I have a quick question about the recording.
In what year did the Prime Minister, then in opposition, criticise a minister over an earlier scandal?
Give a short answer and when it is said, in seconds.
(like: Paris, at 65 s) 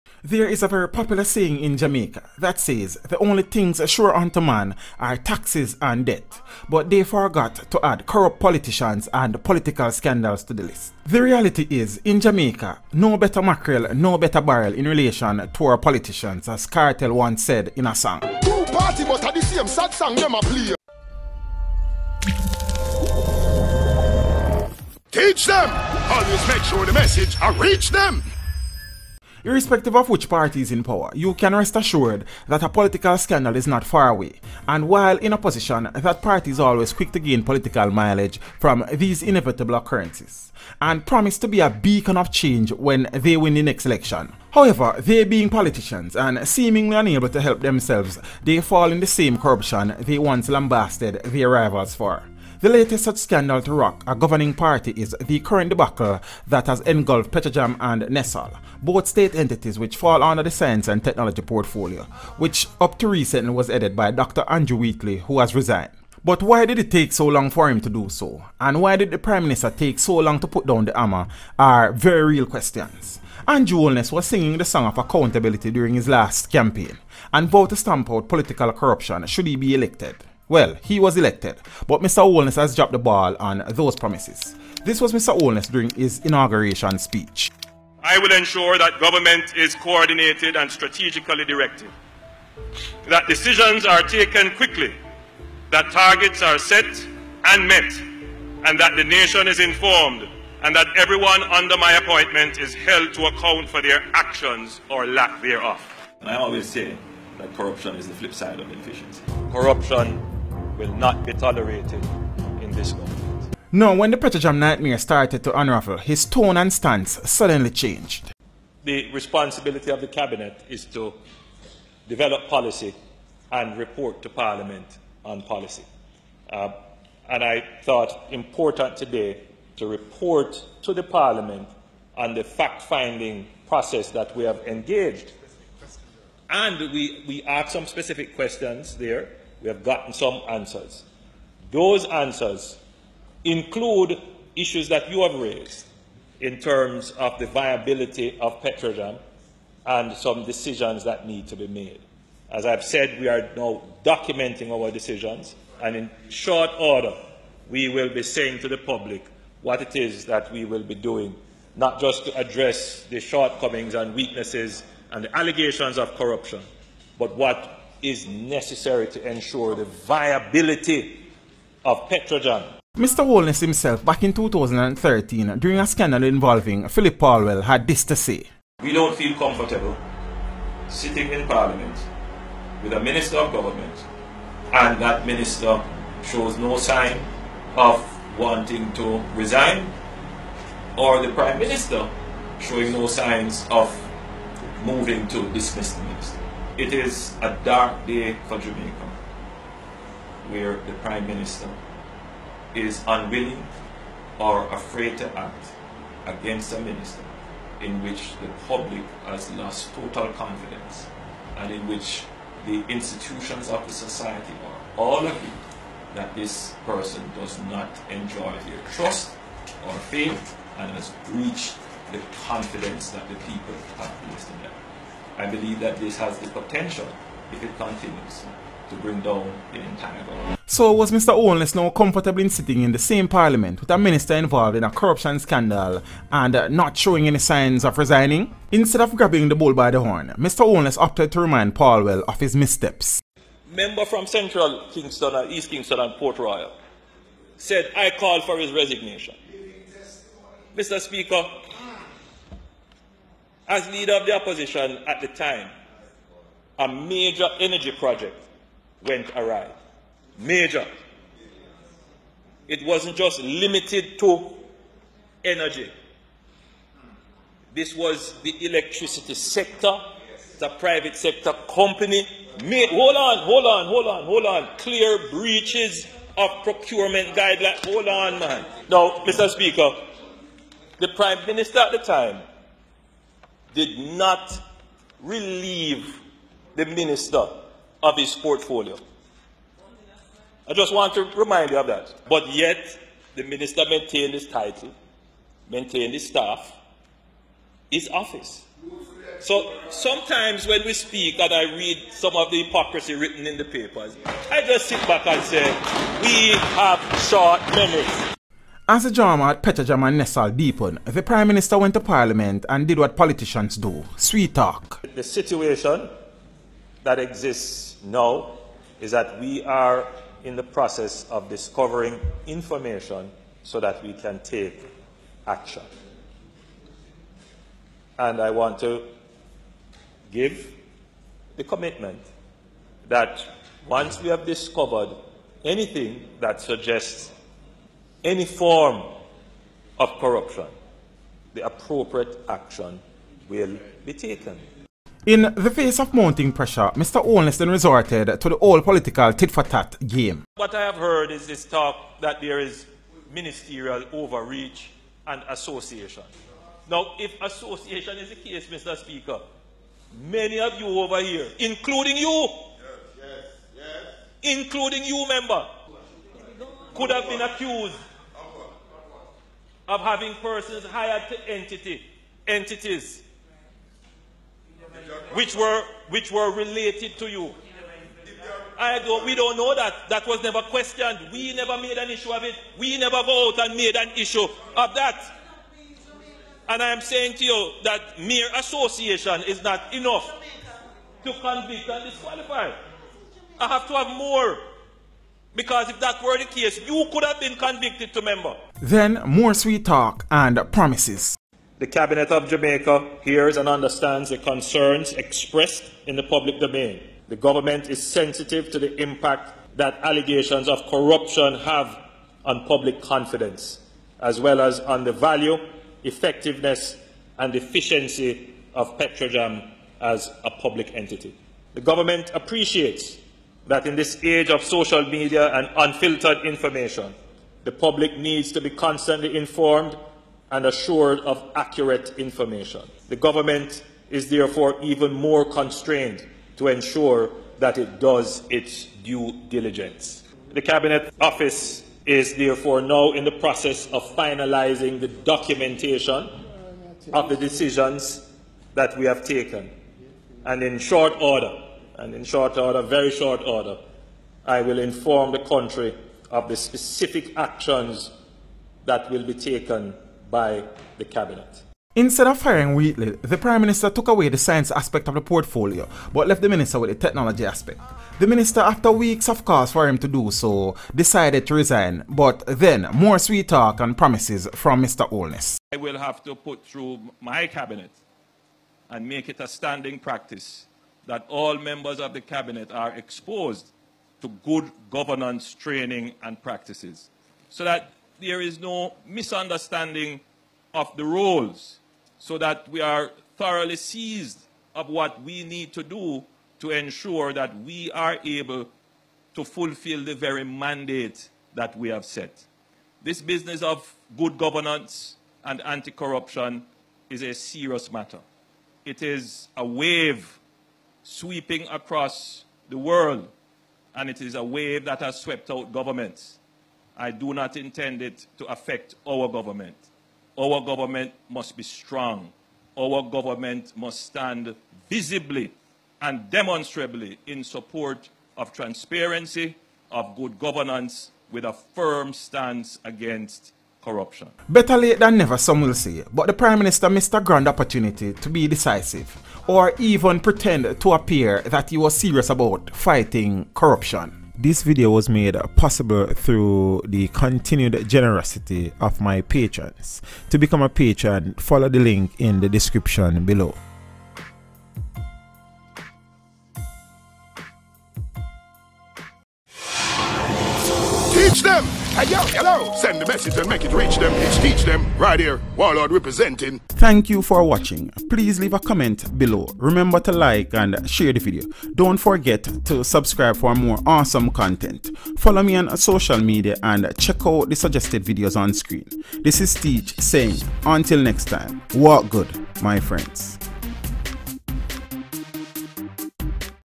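2013, at 174 s.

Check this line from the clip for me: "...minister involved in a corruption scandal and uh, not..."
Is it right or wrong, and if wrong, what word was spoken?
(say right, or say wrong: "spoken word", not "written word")
right.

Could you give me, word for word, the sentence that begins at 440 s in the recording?
The Cabinet Office is therefore now in the process of finalising the documentation of the decisions that we have taken.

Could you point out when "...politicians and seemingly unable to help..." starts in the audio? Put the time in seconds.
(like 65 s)
45 s.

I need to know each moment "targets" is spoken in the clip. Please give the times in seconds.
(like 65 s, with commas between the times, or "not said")
95 s.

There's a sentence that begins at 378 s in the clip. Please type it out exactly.
I don't, we don't know that.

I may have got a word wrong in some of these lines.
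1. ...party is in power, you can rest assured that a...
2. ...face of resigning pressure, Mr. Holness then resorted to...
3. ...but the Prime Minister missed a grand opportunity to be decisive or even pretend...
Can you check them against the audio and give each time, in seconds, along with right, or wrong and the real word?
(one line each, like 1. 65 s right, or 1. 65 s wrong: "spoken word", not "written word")
1. 30 s right
2. 345 s wrong: "mounting", not "resigning"
3. 536 s right.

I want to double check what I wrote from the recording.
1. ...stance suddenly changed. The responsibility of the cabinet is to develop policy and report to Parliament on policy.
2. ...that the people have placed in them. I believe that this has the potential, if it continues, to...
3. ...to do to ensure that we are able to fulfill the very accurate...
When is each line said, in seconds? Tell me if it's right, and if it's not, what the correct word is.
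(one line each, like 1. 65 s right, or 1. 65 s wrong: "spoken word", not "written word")
1. 116 s right
2. 223 s right
3. 495 s wrong: "mandate", not "accurate".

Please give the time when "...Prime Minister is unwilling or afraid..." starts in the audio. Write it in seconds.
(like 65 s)
201 s.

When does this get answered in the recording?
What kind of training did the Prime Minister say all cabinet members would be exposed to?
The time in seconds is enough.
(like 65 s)
484 s.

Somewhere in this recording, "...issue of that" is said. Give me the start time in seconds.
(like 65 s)
384 s.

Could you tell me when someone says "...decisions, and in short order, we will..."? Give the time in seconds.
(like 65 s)
154 s.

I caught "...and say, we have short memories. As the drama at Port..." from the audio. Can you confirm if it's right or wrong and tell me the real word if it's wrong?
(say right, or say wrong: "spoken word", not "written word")
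wrong: "Petrojam", not "Port".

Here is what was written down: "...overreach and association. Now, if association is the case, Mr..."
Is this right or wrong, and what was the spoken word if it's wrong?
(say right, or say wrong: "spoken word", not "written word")
right.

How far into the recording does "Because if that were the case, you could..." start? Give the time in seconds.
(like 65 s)
395 s.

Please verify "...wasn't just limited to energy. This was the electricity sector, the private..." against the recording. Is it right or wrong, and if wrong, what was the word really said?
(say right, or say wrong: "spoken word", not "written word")
right.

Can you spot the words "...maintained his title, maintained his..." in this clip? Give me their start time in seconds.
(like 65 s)
293 s.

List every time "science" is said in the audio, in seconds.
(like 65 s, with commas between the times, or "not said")
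60 s, 464 s.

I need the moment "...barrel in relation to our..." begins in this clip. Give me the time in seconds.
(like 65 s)
14 s.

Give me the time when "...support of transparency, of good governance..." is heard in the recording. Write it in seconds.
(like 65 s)
527 s.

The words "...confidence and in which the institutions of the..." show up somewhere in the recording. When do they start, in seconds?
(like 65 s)
210 s.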